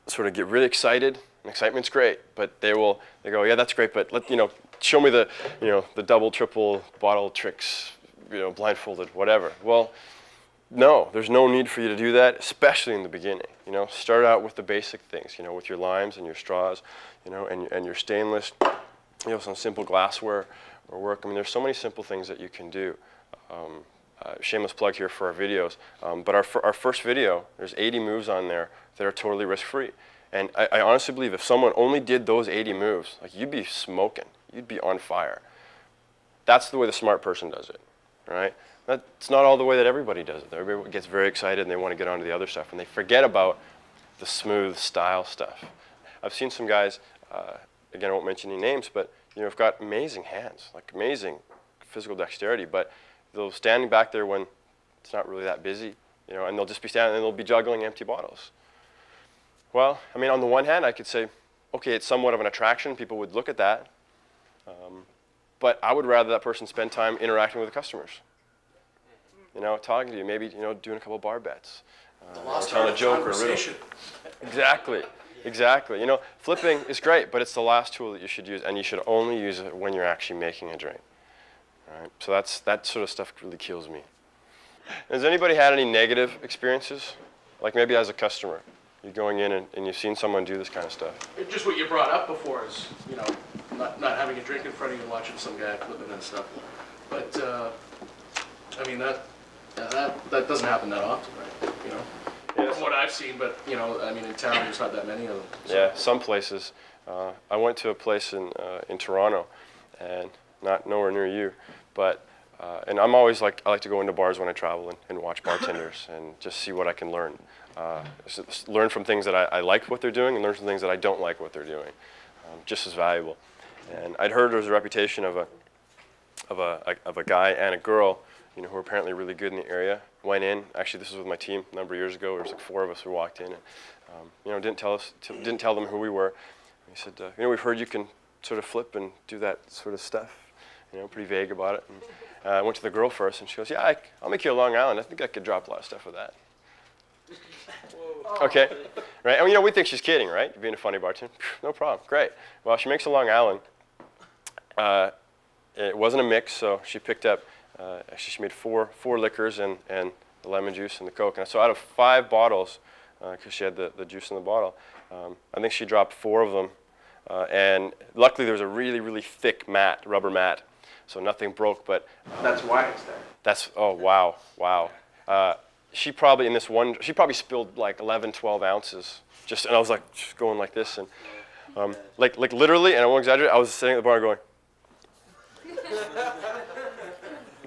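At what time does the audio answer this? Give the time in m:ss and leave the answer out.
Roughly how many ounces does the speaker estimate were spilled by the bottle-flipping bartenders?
2:58.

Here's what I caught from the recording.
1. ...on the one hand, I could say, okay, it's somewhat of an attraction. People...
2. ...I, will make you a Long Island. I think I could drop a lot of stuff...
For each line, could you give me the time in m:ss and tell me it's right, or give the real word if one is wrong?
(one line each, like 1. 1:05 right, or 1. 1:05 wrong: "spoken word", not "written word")
1. 1:00 right
2. 2:23 right.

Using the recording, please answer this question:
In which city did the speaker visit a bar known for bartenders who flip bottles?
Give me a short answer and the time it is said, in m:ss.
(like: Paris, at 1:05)
Toronto, at 1:48.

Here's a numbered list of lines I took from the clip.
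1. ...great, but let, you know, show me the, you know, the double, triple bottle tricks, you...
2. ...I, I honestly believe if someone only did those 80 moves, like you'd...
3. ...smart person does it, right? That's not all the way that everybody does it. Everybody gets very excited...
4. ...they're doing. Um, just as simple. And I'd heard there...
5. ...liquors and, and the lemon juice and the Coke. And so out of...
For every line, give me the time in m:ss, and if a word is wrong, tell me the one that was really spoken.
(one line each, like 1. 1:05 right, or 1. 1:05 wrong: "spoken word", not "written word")
1. 0:03 right
2. 0:30 right
3. 0:36 right
4. 2:01 wrong: "valuable", not "simple"
5. 2:39 right.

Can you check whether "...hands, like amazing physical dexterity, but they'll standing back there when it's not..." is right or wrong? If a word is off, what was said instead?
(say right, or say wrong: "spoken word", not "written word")
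right.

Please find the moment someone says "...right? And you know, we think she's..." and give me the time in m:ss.
2:29.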